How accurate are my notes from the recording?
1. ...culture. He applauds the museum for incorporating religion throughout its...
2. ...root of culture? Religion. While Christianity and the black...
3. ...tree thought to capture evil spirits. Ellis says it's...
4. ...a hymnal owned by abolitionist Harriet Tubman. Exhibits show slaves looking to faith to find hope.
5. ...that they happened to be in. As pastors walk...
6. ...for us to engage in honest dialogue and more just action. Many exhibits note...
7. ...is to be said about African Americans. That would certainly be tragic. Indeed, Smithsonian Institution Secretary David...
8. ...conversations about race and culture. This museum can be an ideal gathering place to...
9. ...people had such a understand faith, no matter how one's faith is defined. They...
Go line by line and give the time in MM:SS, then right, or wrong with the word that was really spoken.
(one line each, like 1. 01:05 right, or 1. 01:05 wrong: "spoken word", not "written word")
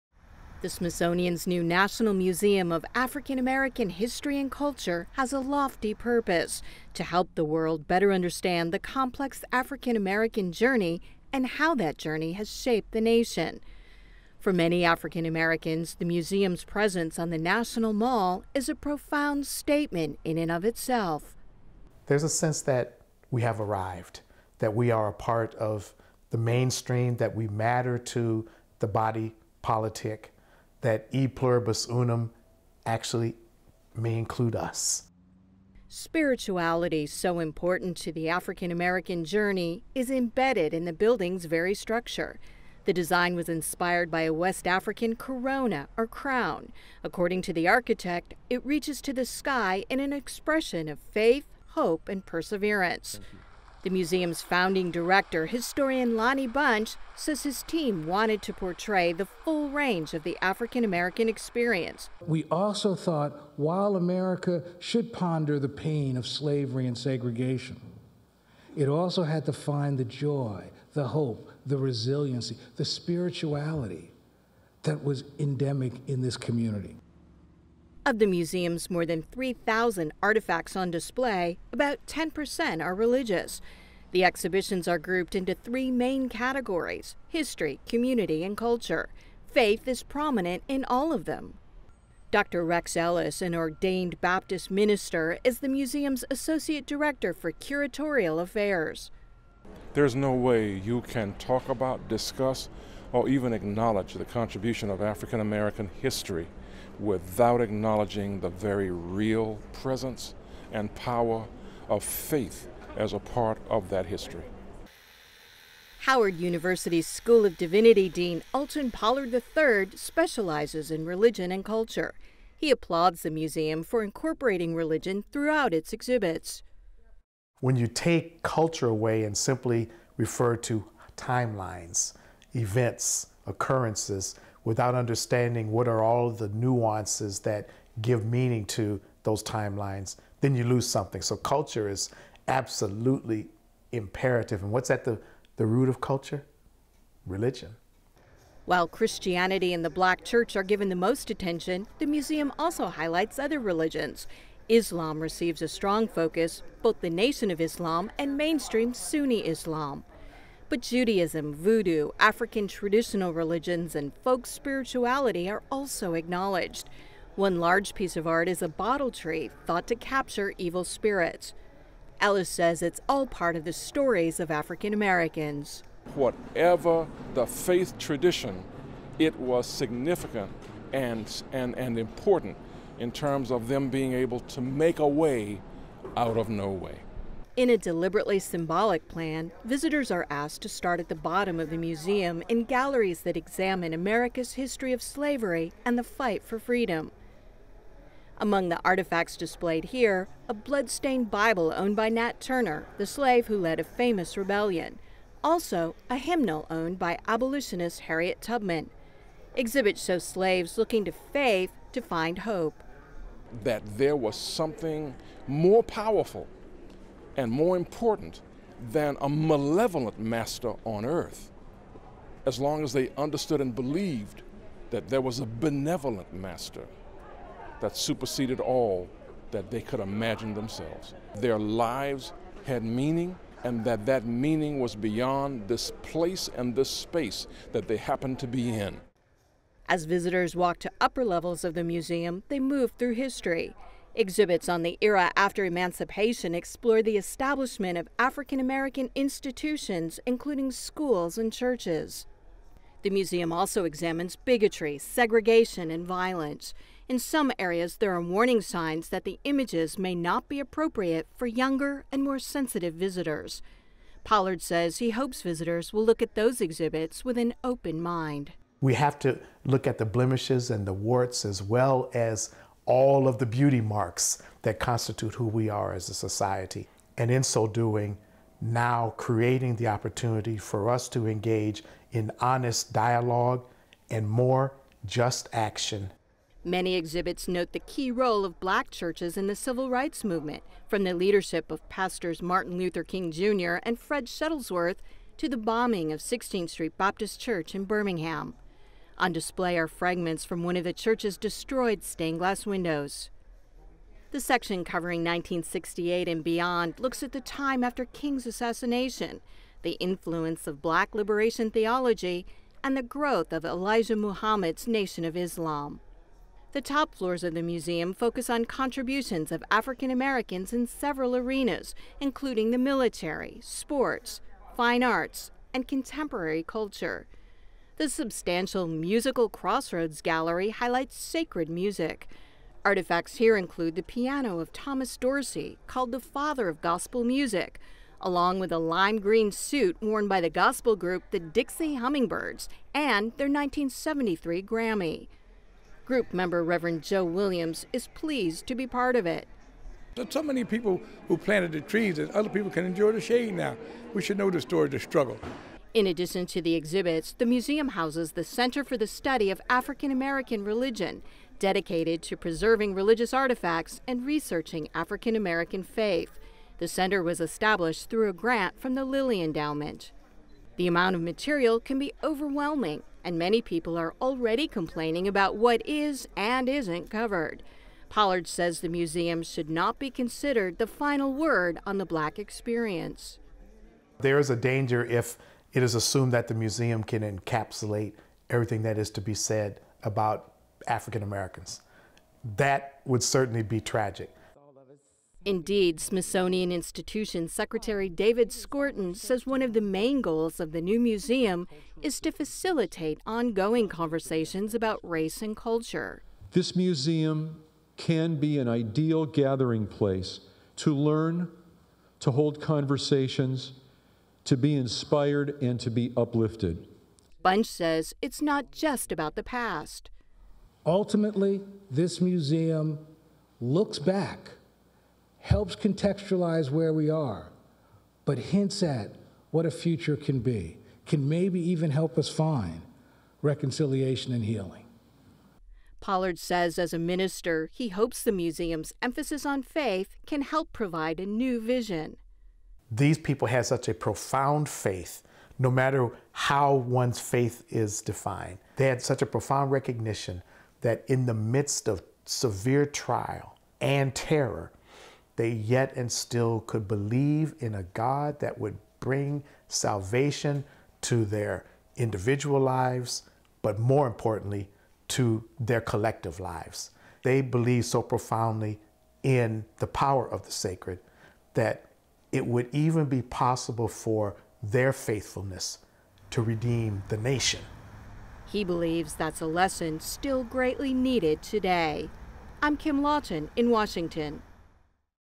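1. 02:01 right
2. 02:25 right
3. 02:49 right
4. 03:26 right
5. 03:57 wrong: "visitors", not "pastors"
6. 04:40 right
7. 06:28 right
8. 06:43 right
9. 07:23 wrong: "profound", not "understand".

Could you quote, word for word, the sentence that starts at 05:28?
The substantial Musical Crossroads Gallery highlights sacred music.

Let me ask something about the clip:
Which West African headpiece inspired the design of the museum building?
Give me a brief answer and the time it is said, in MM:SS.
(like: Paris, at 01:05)
Corona or crown, at 00:44.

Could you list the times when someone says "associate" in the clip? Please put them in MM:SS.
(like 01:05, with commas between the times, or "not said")
01:36.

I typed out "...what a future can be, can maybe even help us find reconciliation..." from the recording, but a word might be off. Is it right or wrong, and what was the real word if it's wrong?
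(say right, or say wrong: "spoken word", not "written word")
right.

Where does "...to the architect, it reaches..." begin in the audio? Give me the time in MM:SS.
00:47.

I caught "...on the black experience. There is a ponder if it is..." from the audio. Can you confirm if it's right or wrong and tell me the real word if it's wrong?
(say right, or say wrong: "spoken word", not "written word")
wrong: "danger", not "ponder".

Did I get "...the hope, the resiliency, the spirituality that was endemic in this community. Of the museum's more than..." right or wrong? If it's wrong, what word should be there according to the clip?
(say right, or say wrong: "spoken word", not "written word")
right.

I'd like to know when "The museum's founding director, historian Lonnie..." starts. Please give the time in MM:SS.
00:53.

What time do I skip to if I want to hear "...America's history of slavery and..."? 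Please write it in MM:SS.
03:13.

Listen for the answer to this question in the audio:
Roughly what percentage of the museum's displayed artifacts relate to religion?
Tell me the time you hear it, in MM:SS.
01:22.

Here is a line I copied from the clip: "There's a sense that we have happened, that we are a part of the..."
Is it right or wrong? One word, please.
wrong.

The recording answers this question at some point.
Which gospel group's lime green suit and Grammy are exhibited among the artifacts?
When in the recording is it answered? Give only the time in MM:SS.
05:41.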